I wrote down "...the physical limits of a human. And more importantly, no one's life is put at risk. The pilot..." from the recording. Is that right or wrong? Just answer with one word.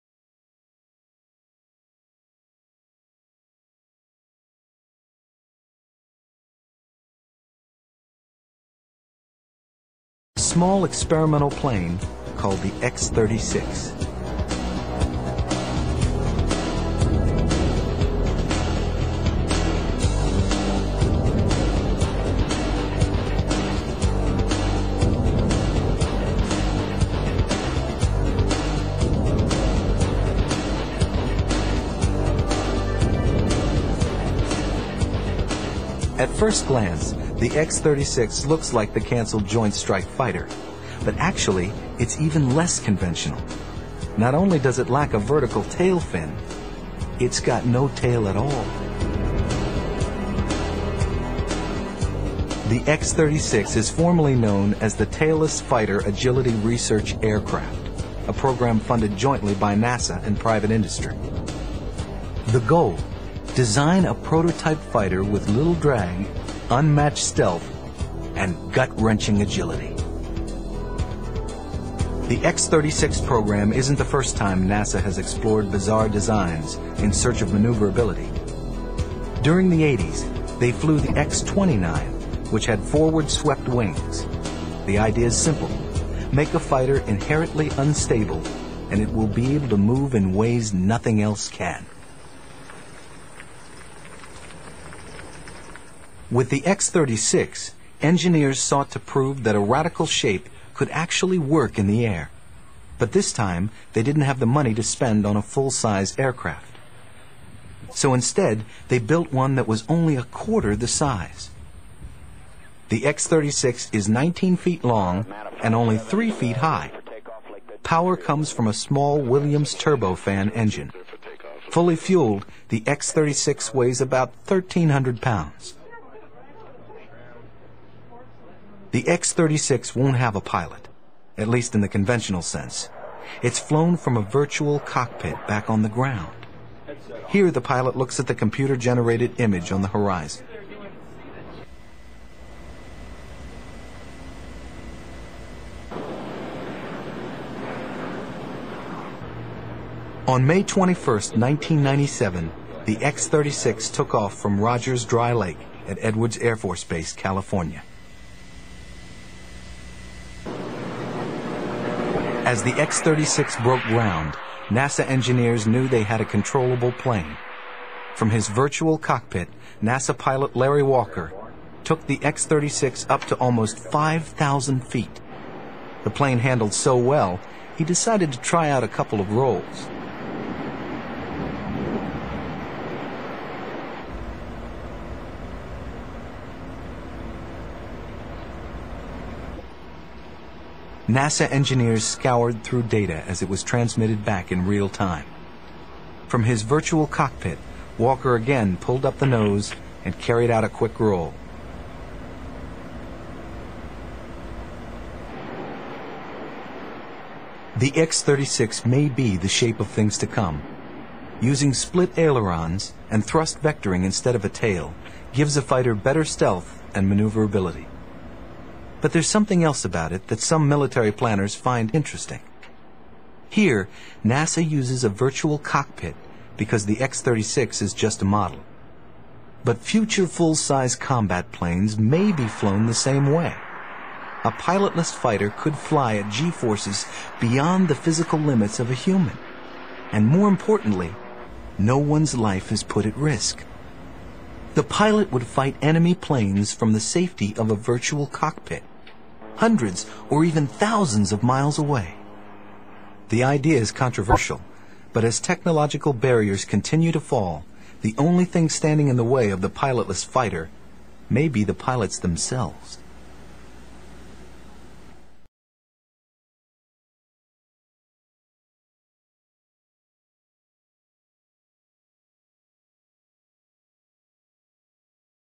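right.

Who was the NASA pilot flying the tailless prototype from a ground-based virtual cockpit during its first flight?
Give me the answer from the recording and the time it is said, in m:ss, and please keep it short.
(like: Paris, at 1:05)
Larry Walker, at 2:50.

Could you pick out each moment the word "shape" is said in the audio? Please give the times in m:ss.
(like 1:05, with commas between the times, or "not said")
1:40, 3:29.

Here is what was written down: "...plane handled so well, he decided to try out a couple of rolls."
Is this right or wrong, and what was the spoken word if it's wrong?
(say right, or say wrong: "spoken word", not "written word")
right.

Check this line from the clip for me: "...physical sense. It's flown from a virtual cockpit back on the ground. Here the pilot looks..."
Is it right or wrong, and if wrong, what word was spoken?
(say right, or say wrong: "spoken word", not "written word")
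wrong: "conventional", not "physical".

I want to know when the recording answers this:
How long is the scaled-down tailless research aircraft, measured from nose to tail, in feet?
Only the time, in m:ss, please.
1:54.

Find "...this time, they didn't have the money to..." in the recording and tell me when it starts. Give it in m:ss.
1:43.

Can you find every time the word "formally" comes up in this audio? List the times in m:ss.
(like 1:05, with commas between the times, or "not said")
0:53.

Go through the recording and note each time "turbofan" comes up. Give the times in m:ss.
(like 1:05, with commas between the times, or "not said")
1:59.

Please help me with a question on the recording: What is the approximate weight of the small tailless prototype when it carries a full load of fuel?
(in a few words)
1,300 pounds.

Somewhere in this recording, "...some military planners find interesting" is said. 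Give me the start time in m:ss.
3:40.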